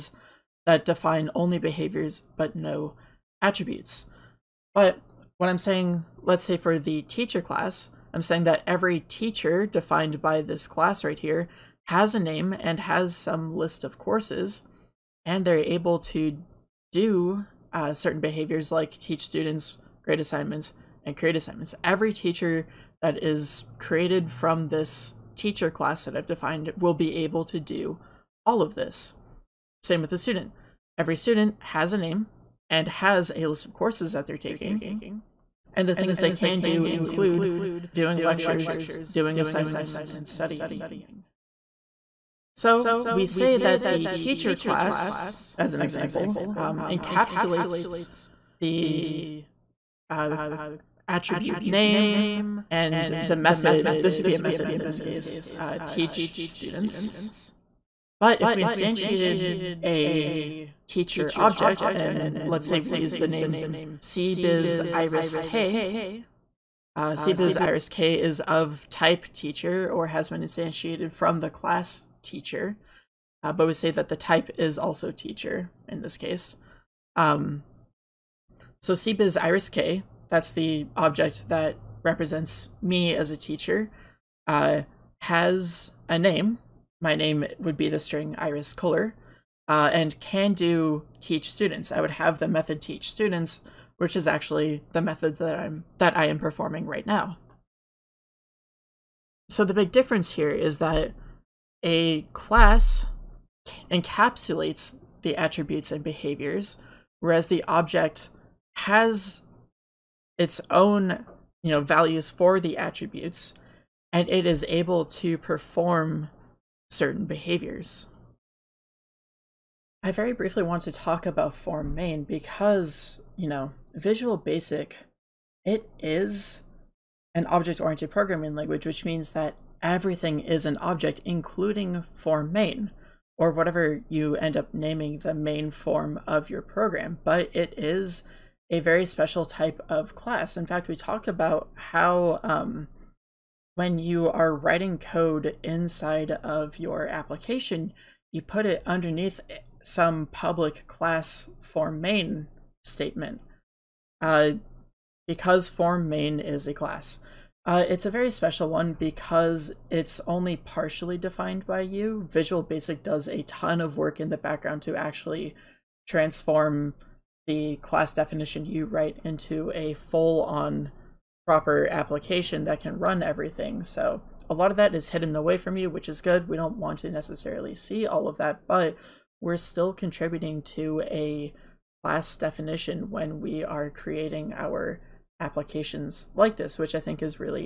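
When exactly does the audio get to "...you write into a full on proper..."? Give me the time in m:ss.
2:48.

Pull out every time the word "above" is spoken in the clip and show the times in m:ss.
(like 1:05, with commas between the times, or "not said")
not said.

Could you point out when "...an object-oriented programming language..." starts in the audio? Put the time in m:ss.
2:07.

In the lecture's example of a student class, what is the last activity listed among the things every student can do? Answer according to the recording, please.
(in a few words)
Studying.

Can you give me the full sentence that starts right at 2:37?
Uh, it's a very special one because it's only partially defined by you.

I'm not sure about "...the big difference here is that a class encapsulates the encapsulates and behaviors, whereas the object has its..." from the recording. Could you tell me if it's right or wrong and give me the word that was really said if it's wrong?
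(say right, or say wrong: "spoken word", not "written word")
wrong: "attributes", not "encapsulates".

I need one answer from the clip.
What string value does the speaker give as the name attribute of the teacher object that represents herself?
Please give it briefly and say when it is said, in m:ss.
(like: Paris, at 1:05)
Iris Kohler, at 1:28.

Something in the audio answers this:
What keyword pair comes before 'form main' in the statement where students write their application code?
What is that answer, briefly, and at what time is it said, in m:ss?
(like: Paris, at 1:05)
Public class, at 2:30.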